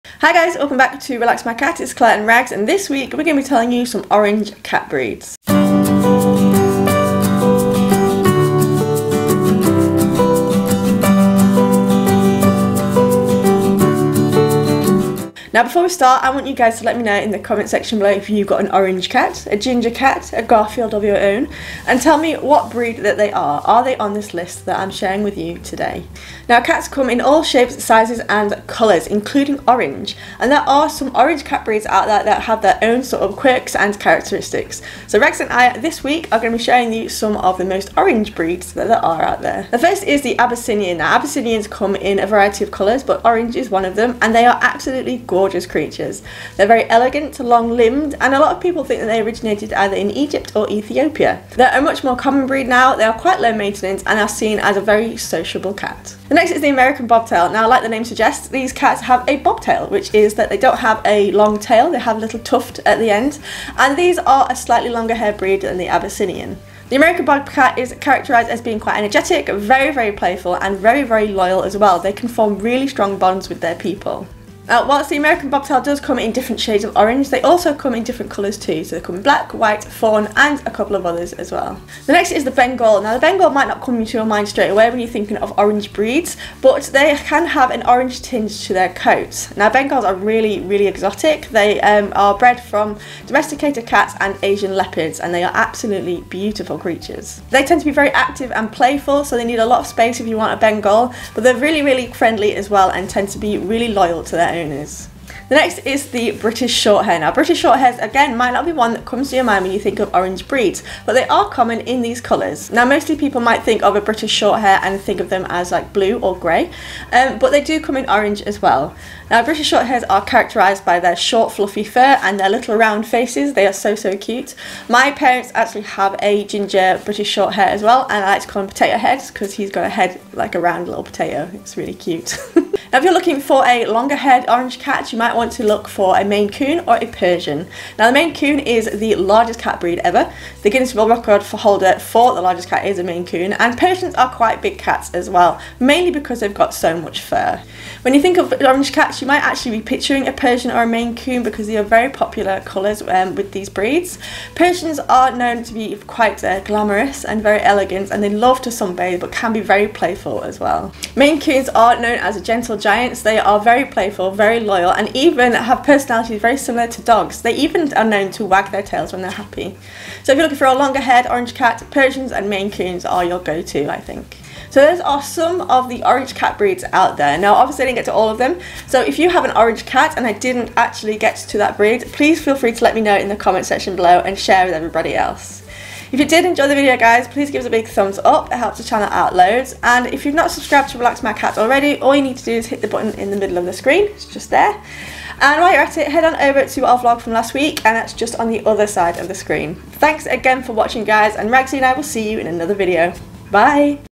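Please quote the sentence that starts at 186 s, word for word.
If you did enjoy the video guys, please give us a big thumbs up, it helps the channel out loads.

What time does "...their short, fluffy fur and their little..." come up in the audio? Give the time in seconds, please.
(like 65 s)
121 s.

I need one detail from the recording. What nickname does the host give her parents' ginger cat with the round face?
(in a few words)
Potato Head.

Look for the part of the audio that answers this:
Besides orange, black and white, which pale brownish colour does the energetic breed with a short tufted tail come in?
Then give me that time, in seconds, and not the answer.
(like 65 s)
79 s.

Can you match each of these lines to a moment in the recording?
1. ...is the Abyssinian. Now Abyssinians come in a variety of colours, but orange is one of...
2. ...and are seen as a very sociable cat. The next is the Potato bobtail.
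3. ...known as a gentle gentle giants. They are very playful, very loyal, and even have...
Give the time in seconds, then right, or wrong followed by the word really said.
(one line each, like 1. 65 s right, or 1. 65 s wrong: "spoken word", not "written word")
1. 40 s right
2. 54 s wrong: "American", not "Potato"
3. 161 s right.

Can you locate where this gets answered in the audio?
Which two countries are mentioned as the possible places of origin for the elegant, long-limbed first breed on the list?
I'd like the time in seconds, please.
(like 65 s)
50 s.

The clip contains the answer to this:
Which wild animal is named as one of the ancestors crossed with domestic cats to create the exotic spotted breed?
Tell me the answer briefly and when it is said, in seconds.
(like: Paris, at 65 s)
Asian leopards, at 94 s.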